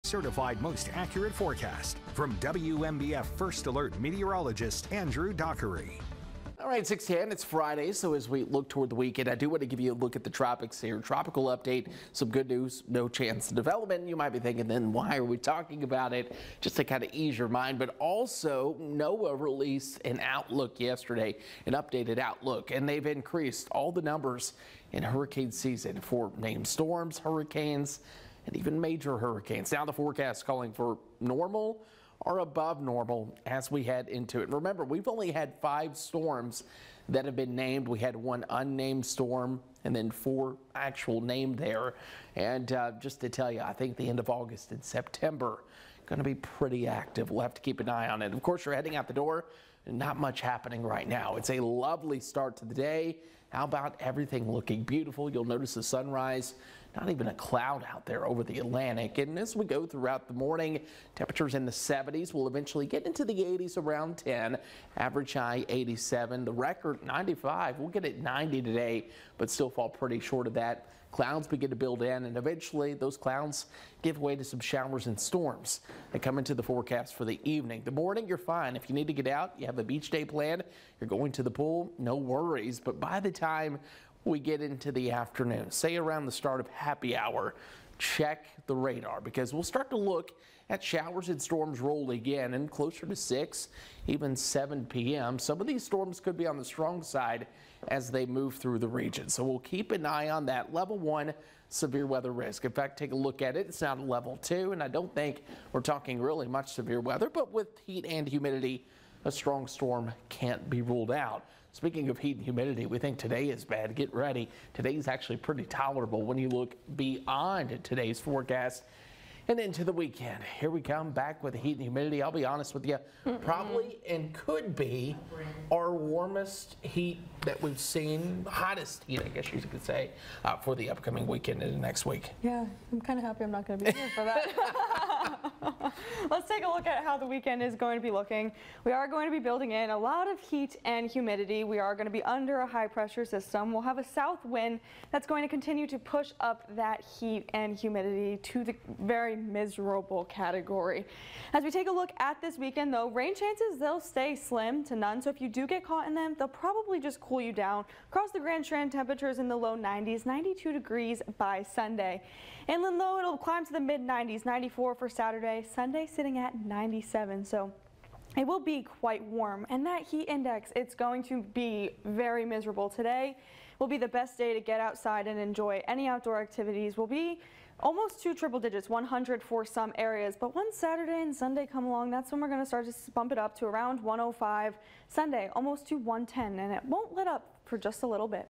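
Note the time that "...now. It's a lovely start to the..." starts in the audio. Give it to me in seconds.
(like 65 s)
51 s.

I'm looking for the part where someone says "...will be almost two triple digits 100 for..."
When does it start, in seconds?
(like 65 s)
176 s.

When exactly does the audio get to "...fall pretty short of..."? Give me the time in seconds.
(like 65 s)
69 s.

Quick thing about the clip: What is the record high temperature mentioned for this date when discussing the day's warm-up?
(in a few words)
95.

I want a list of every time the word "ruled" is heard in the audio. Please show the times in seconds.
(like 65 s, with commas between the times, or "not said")
110 s.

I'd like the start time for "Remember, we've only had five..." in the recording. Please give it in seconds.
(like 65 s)
34 s.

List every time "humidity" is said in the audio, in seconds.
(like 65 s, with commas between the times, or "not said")
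108 s, 112 s, 121 s, 141 s, 147 s.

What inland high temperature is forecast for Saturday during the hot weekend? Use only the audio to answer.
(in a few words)
94.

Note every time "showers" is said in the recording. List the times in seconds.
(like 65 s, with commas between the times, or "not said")
74 s, 90 s.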